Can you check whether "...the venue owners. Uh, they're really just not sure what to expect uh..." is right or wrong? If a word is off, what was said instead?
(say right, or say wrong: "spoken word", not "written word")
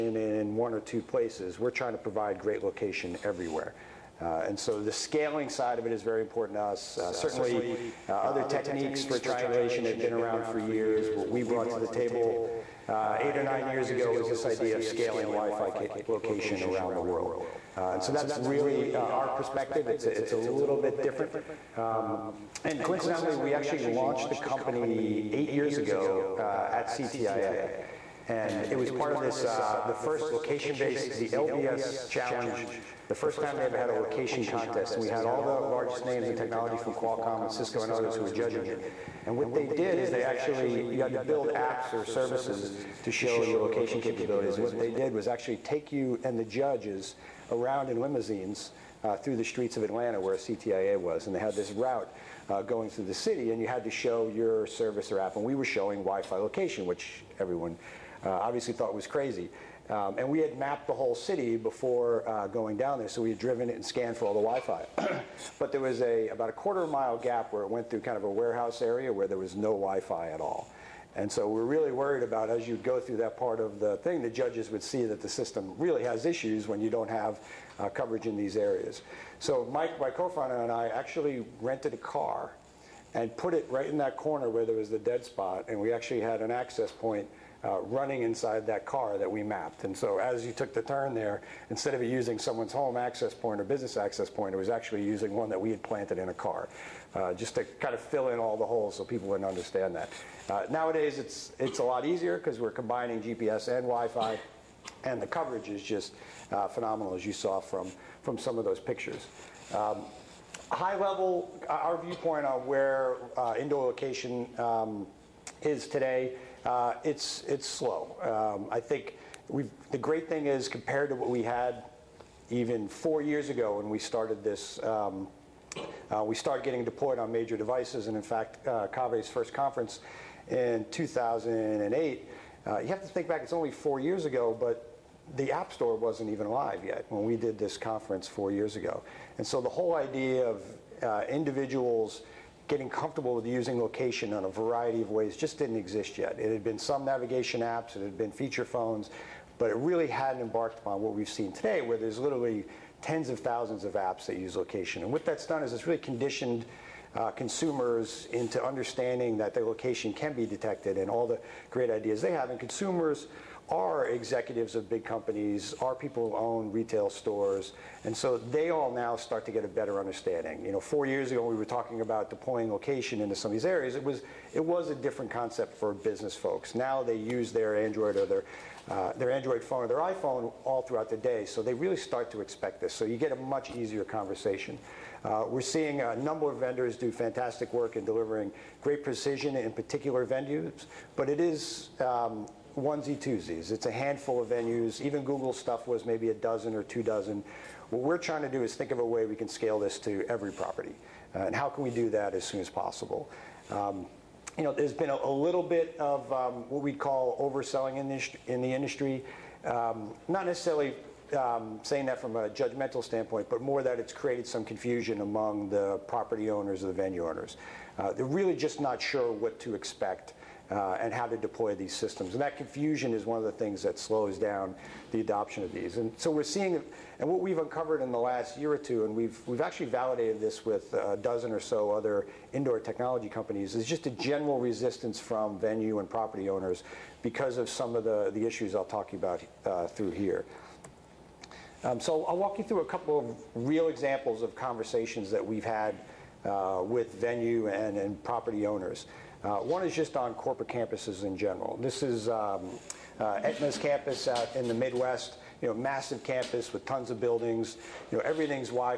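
right.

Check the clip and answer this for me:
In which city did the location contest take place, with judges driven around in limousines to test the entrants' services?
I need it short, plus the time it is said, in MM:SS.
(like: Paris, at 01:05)
Atlanta, at 00:49.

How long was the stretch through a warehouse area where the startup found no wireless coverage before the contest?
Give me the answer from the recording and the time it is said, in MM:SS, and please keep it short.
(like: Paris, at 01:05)
a quarter mile, at 01:06.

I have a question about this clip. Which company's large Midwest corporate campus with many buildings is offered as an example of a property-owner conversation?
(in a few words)
Aetna.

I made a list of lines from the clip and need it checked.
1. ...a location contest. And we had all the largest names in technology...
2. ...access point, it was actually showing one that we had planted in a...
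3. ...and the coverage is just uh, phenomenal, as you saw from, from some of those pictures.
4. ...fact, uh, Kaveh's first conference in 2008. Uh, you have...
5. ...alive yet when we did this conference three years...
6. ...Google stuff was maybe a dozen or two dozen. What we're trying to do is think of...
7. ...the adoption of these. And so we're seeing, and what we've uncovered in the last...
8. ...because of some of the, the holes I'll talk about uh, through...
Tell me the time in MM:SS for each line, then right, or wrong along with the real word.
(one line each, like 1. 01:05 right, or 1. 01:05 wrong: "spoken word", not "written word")
1. 00:33 right
2. 01:33 wrong: "using", not "showing"
3. 01:45 right
4. 02:08 right
5. 02:16 wrong: "four", not "three"
6. 03:15 right
7. 03:45 right
8. 03:57 wrong: "issues", not "holes".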